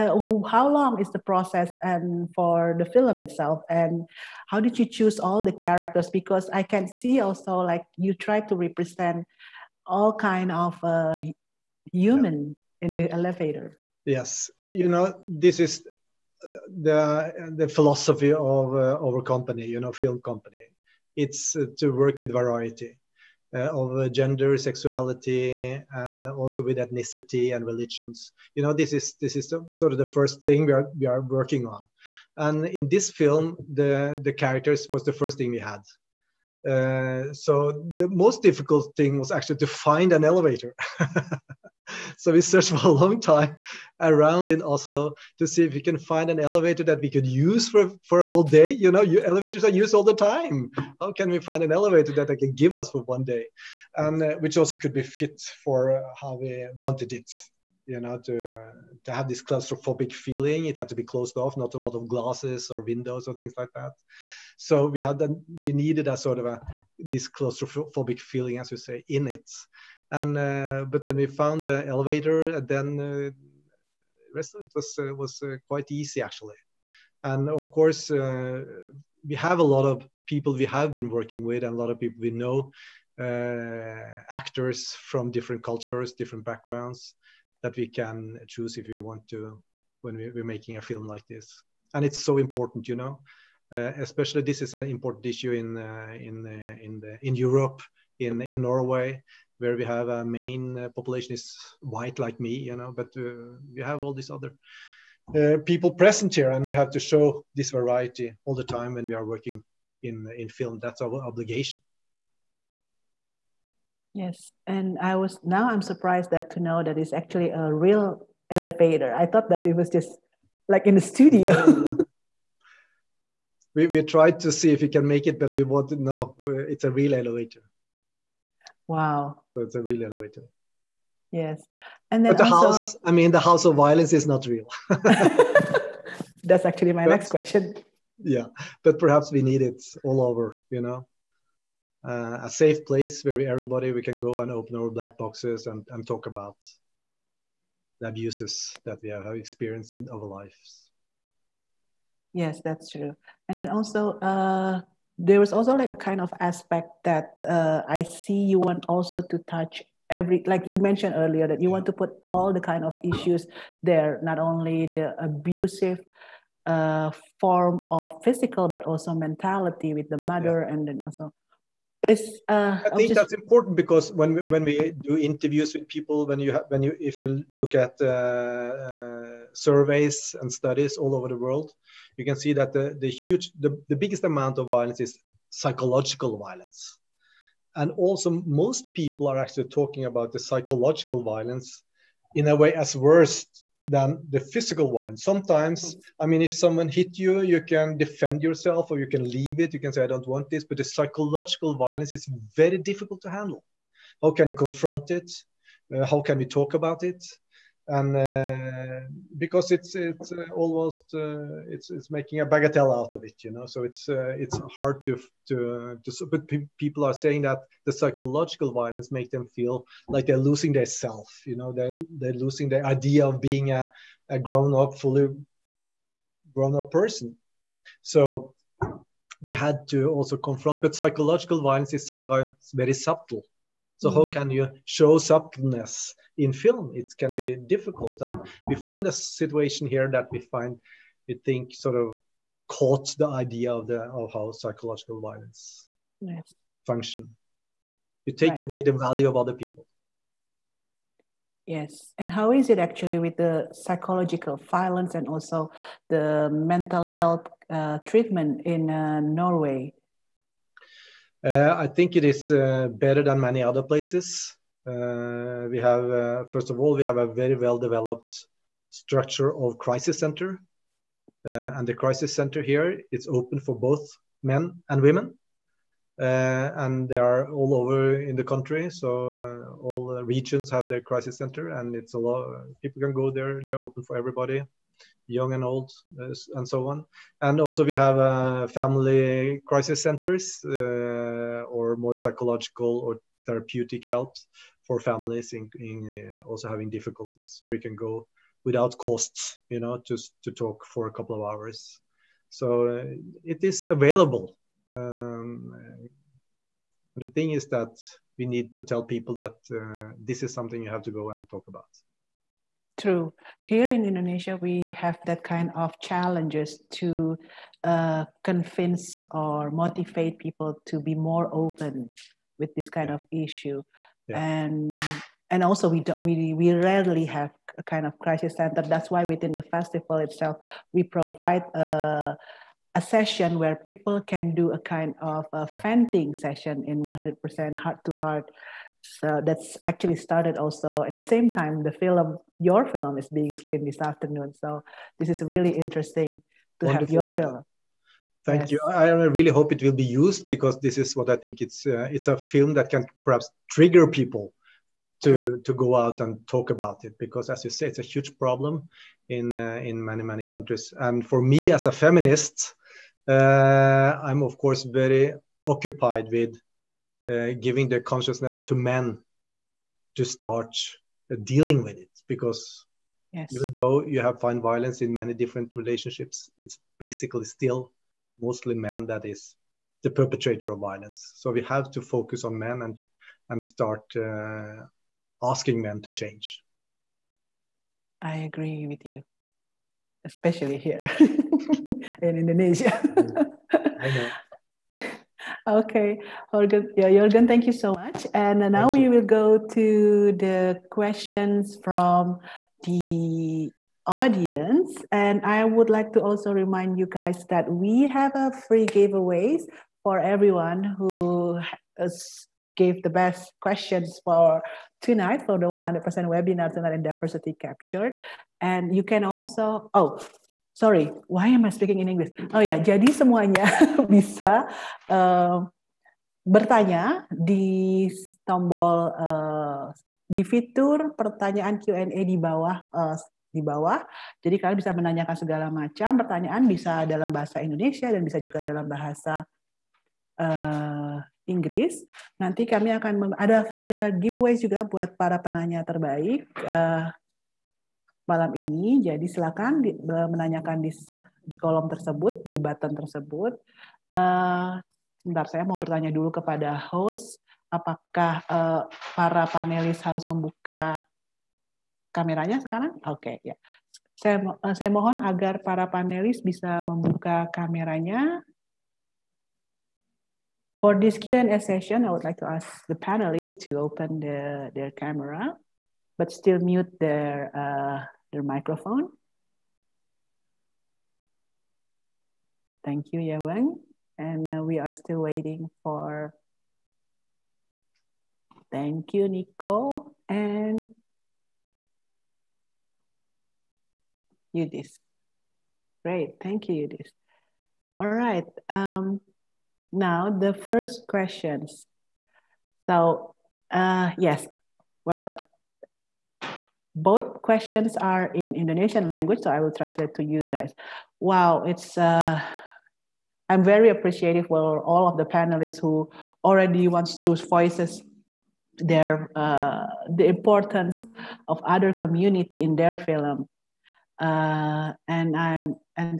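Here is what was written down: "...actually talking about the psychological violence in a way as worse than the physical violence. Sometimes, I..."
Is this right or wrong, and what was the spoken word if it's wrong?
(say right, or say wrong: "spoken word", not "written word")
right.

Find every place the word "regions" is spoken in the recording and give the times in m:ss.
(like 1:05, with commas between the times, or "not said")
4:40.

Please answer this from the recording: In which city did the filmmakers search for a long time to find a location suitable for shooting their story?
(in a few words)
Oslo.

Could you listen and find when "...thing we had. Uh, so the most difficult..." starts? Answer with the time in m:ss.
0:35.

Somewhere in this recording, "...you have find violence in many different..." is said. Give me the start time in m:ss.
6:14.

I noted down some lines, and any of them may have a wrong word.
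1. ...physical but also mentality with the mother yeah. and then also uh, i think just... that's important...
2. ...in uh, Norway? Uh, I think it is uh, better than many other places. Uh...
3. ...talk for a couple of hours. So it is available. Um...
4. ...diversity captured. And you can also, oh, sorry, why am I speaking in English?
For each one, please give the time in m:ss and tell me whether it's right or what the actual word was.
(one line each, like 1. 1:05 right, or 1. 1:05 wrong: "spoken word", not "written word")
1. 2:48 right
2. 4:18 right
3. 5:00 right
4. 6:57 right.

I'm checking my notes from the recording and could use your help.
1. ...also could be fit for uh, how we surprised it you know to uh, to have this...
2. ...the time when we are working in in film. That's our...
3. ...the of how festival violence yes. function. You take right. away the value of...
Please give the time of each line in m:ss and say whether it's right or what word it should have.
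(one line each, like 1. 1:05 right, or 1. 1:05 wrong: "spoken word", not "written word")
1. 0:54 wrong: "wanted", not "surprised"
2. 1:48 right
3. 4:03 wrong: "psychological", not "festival".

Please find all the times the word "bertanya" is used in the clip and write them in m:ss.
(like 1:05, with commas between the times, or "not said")
7:06, 7:35.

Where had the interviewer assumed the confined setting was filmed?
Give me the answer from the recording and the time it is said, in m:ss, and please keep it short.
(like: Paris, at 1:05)
In the studio, at 2:00.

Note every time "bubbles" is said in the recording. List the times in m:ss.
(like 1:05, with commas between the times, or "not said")
not said.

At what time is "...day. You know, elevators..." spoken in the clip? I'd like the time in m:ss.
0:48.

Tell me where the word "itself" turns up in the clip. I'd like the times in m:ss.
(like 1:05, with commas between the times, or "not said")
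0:03, 5:30.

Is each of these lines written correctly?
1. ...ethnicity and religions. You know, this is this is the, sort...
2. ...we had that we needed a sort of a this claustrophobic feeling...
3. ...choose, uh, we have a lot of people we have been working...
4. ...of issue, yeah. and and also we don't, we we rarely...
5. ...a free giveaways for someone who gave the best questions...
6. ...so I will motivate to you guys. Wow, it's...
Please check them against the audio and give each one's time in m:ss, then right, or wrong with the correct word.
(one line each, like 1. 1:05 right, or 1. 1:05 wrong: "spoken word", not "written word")
1. 0:26 right
2. 1:04 right
3. 1:17 wrong: "course", not "choose"
4. 5:23 right
5. 6:48 wrong: "everyone", not "someone"
6. 8:29 wrong: "translate", not "motivate".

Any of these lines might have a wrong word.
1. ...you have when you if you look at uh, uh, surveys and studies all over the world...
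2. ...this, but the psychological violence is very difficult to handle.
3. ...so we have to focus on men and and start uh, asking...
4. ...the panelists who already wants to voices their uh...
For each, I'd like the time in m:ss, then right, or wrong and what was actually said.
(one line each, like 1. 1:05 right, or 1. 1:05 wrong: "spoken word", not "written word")
1. 2:56 right
2. 3:20 right
3. 6:21 right
4. 8:35 right.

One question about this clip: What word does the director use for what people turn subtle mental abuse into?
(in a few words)
A bagatelle.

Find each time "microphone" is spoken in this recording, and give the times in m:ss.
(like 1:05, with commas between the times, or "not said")
7:58.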